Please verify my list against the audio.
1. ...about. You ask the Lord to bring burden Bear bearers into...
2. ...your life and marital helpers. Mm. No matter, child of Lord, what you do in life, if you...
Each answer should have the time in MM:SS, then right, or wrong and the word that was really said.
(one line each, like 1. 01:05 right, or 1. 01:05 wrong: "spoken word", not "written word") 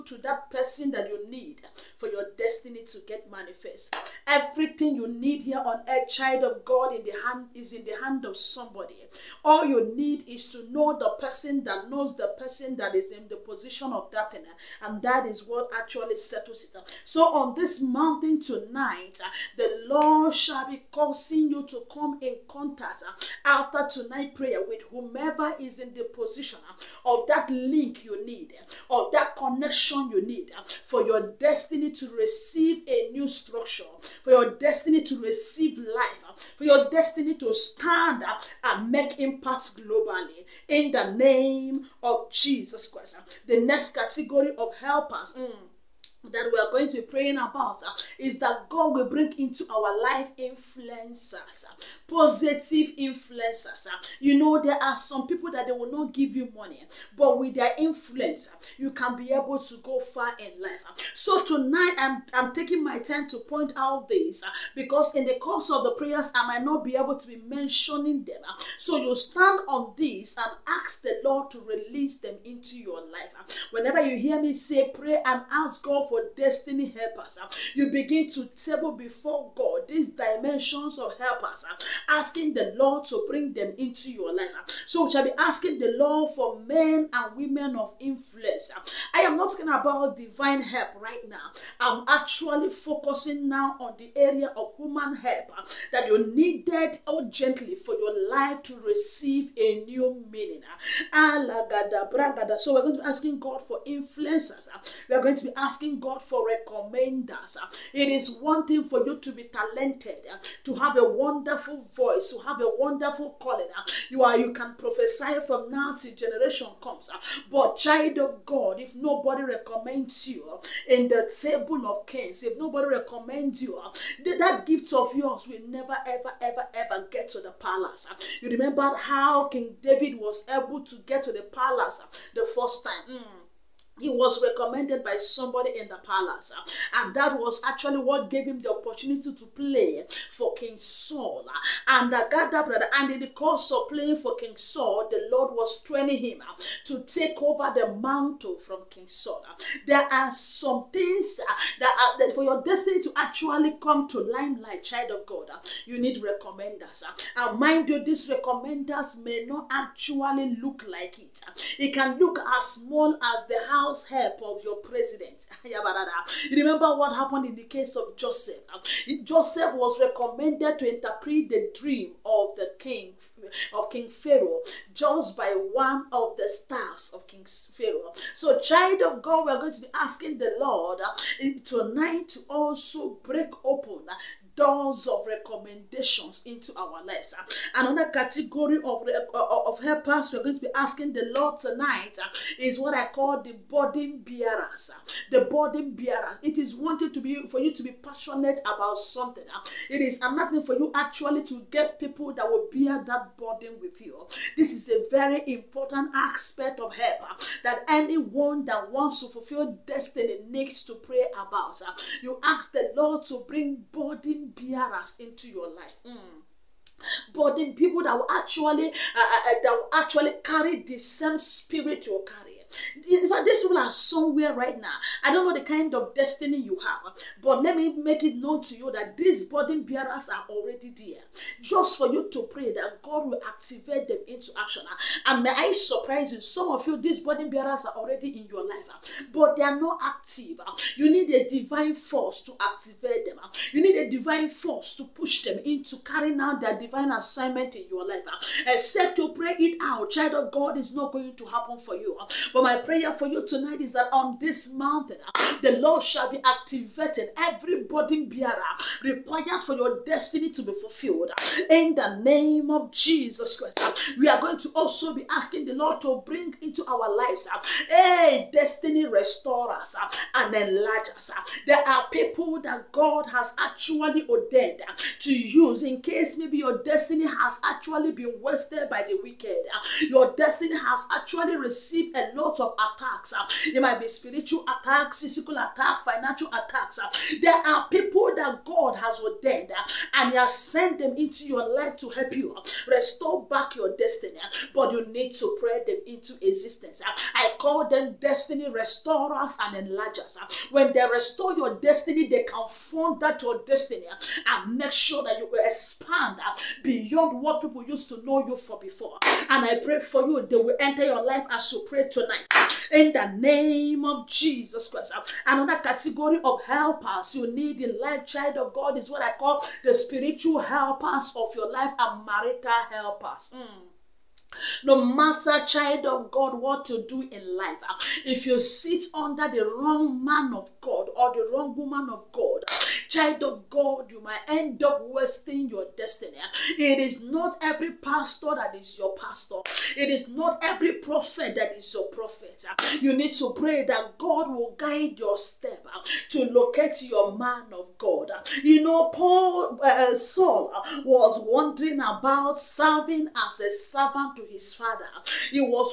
1. 03:31 right
2. 05:21 wrong: "God", not "Lord".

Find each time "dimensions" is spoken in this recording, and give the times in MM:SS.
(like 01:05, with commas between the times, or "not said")
01:20.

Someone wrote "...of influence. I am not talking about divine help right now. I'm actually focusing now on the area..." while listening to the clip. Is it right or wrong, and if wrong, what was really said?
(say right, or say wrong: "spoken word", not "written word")
right.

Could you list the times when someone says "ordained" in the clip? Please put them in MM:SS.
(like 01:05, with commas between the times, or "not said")
04:34, 04:49.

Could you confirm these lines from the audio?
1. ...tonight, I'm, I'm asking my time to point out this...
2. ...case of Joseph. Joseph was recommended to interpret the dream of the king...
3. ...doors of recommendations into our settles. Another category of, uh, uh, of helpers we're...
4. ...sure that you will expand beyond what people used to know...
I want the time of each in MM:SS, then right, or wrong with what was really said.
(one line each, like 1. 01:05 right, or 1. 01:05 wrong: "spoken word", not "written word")
1. 01:01 wrong: "taking", not "asking"
2. 02:47 right
3. 03:04 wrong: "lives", not "settles"
4. 05:04 right.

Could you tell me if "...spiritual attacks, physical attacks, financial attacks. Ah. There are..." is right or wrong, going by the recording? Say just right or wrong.
right.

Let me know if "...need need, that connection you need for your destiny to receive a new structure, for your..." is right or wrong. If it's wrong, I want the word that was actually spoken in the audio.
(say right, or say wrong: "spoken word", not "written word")
right.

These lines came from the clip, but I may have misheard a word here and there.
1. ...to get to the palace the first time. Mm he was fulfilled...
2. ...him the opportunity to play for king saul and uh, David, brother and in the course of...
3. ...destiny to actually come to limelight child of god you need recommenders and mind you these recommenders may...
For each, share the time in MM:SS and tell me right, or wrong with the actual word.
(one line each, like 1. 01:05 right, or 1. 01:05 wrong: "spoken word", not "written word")
1. 02:10 wrong: "recommended", not "fulfilled"
2. 02:18 wrong: "God", not "David"
3. 02:32 right.